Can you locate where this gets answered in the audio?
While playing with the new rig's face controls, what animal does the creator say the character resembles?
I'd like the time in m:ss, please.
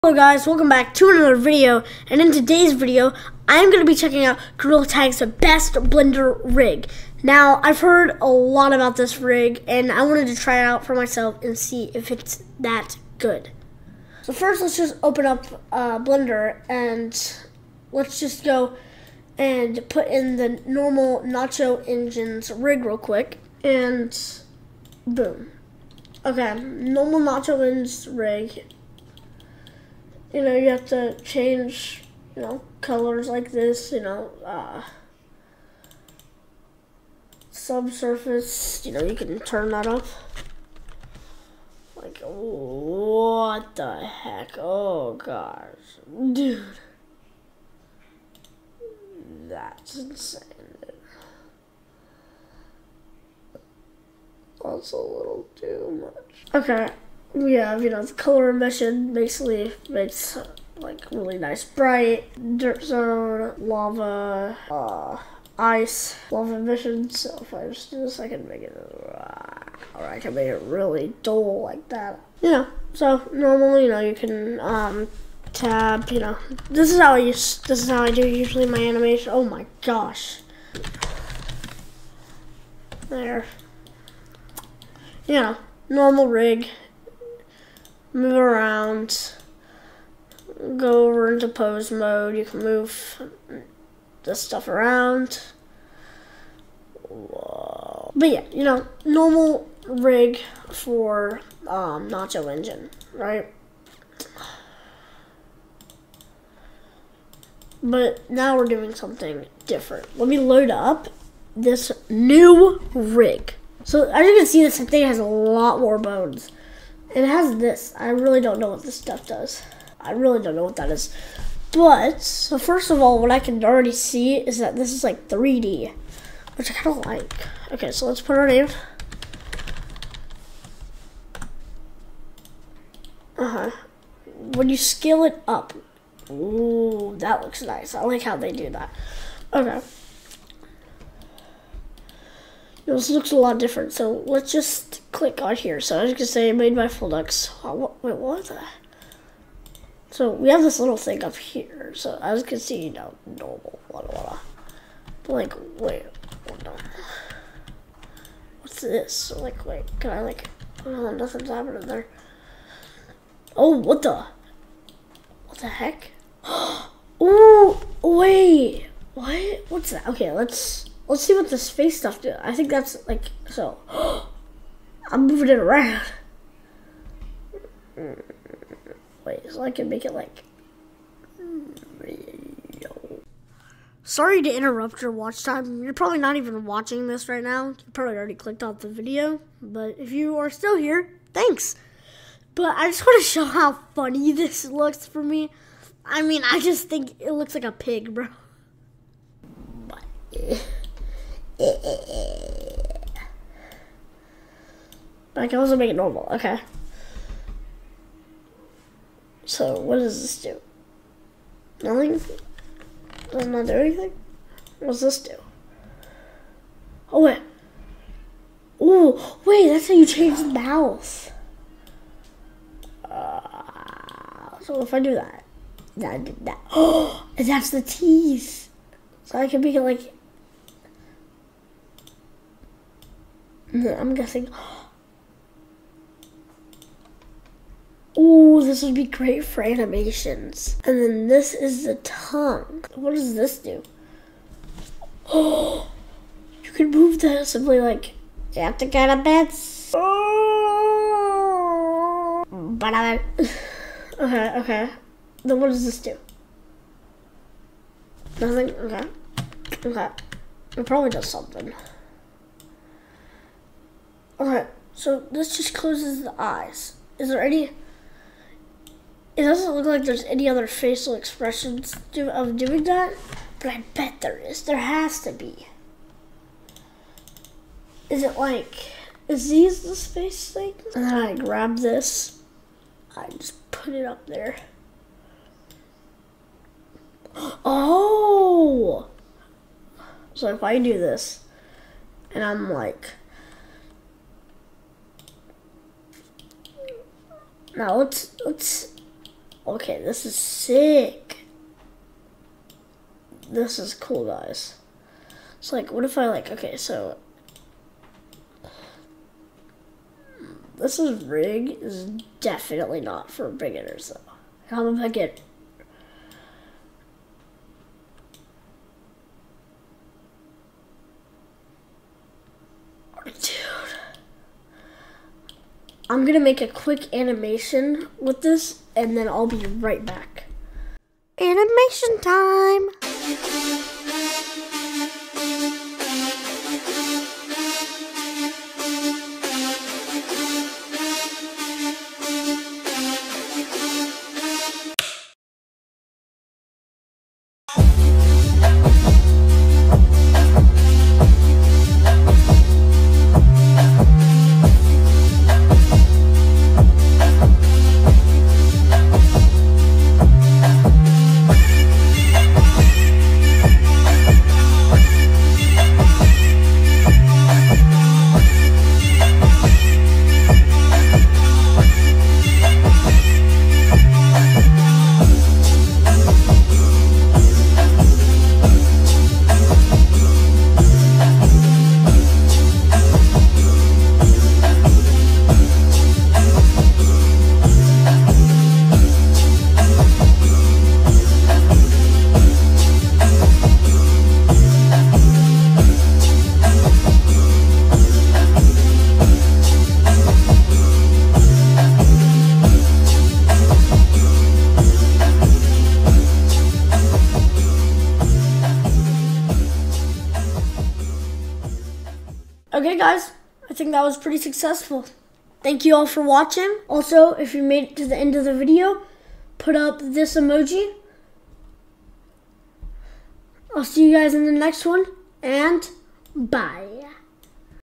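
3:17.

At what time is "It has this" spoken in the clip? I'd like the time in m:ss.
1:57.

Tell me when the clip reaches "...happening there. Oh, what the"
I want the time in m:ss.
2:41.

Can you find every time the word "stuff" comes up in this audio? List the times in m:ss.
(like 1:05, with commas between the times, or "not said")
1:34, 1:58, 2:51.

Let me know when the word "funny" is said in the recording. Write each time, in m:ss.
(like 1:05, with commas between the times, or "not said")
3:13.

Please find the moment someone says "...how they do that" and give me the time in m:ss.
2:18.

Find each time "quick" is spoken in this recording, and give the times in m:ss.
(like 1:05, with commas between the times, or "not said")
0:22, 5:26.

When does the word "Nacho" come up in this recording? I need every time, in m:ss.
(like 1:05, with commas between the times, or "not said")
0:21, 0:27, 1:42.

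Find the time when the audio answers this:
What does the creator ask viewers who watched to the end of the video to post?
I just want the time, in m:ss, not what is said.
7:00.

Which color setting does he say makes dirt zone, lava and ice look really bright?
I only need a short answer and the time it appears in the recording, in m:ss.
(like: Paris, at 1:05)
color emission, at 0:58.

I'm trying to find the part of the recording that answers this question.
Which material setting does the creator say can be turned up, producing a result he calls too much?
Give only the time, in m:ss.
0:37.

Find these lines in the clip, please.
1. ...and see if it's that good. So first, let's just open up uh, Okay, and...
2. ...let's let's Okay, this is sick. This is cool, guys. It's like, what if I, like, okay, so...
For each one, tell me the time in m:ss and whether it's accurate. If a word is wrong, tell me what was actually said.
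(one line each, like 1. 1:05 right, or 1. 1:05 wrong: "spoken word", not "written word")
1. 0:11 wrong: "Blender", not "Okay"
2. 4:57 right.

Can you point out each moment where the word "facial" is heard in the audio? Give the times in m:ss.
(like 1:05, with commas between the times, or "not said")
4:30.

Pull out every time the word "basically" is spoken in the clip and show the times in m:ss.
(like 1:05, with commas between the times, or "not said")
0:59.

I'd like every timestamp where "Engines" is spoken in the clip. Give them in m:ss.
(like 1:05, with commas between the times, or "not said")
0:21, 0:27, 1:42.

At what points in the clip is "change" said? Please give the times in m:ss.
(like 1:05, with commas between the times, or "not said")
0:31, 3:40.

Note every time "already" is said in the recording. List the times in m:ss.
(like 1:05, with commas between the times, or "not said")
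2:03, 3:08.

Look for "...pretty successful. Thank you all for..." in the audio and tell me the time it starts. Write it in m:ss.
6:54.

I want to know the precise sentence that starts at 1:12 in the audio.
You know, so normally, you know, you can um, tab.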